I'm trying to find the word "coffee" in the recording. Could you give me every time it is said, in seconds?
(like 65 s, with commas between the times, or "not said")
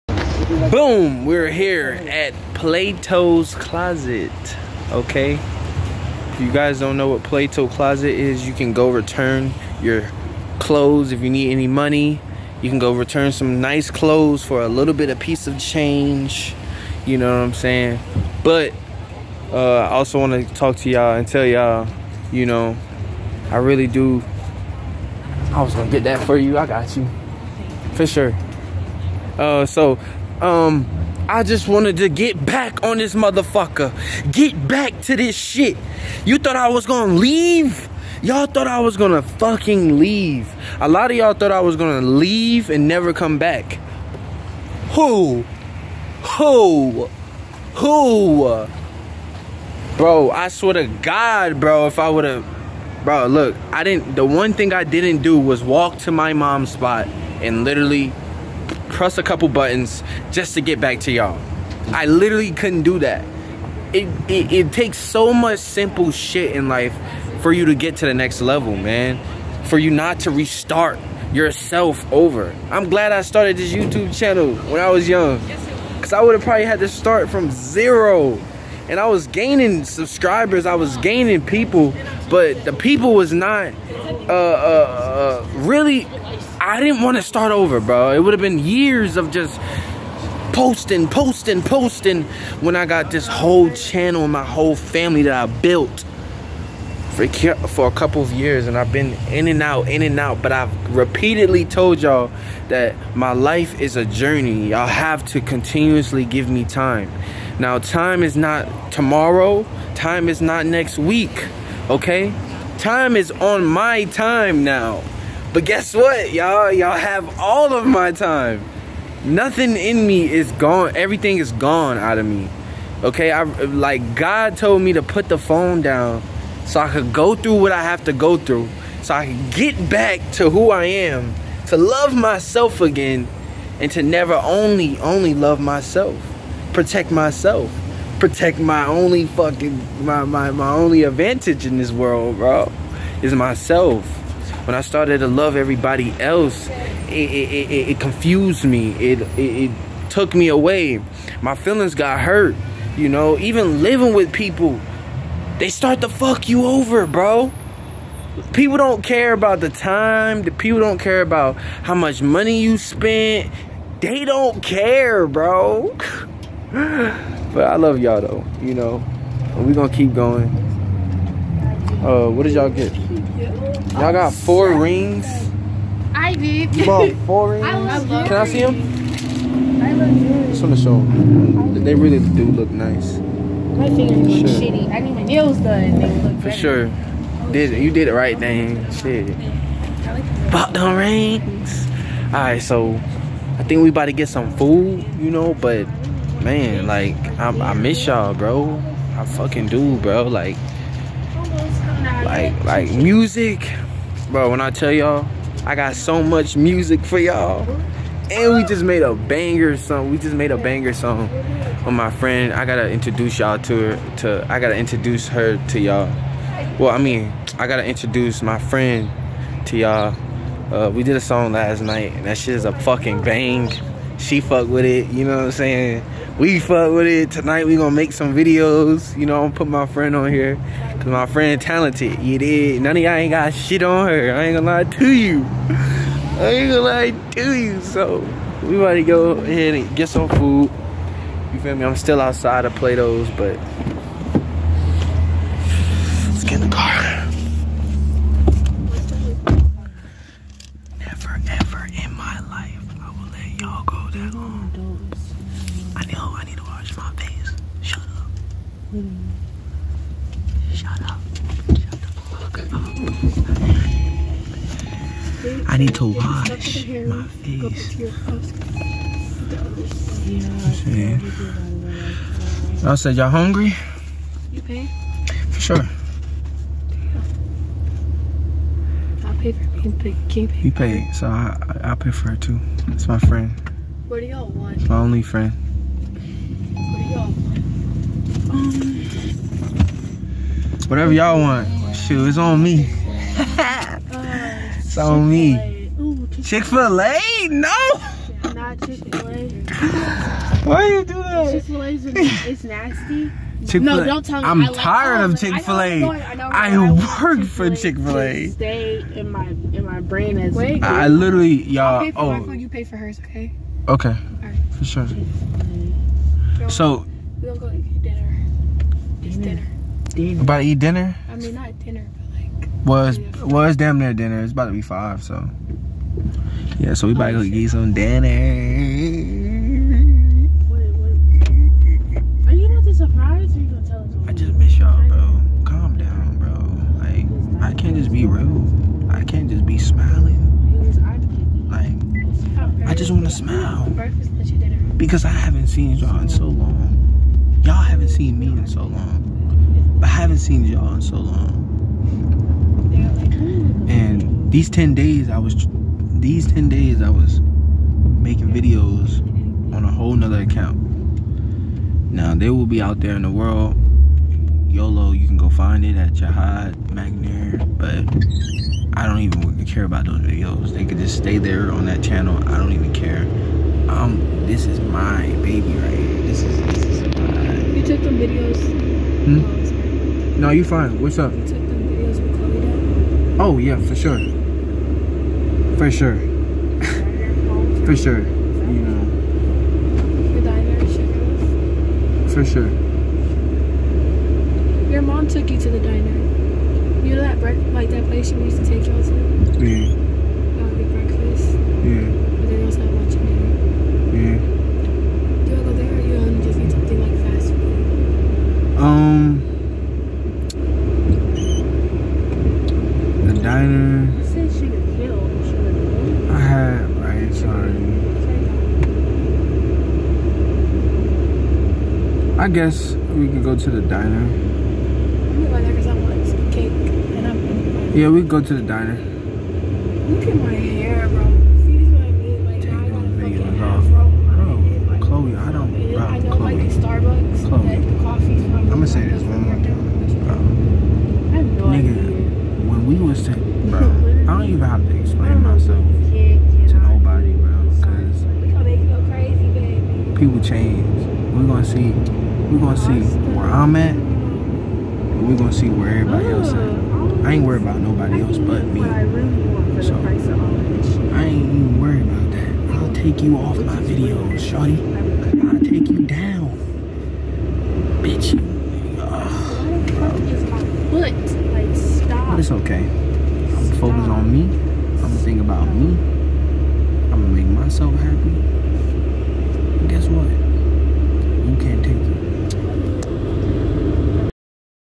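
438 s.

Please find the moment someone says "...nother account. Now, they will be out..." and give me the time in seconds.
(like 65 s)
360 s.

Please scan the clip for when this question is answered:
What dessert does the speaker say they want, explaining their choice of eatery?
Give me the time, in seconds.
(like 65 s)
426 s.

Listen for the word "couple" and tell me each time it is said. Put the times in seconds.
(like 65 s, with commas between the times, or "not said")
59 s, 97 s.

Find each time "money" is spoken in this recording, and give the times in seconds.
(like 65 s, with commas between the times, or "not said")
11 s, 162 s.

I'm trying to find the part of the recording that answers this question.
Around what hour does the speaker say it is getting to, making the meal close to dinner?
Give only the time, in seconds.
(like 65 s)
324 s.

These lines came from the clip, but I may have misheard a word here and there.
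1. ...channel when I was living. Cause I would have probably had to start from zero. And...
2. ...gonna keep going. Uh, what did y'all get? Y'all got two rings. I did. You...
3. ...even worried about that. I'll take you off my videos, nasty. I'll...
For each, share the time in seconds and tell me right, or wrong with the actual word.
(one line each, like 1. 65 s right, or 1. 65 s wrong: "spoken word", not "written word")
1. 74 s wrong: "young", not "living"
2. 169 s wrong: "four", not "two"
3. 461 s wrong: "shorty", not "nasty".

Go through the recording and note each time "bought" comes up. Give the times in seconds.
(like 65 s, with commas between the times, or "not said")
176 s, 190 s.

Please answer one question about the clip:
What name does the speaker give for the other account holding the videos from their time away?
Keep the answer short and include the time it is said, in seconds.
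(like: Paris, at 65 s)
Jahad McNair, at 366 s.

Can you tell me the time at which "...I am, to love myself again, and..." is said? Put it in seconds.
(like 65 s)
130 s.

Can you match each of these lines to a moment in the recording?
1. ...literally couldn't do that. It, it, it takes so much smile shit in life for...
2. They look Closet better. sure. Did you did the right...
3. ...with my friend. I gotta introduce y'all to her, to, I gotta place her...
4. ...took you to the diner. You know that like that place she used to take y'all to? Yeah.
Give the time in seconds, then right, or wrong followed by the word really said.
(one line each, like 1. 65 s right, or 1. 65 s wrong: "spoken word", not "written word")
1. 62 s wrong: "simple", not "smile"
2. 185 s wrong: "For", not "Closet"
3. 211 s wrong: "introduce", not "place"
4. 395 s right.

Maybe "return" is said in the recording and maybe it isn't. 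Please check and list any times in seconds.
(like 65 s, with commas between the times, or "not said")
8 s, 12 s.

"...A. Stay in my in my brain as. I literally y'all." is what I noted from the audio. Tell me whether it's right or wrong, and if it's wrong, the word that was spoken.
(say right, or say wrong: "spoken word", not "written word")
right.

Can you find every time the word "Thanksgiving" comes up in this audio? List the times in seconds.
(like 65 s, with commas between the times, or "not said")
not said.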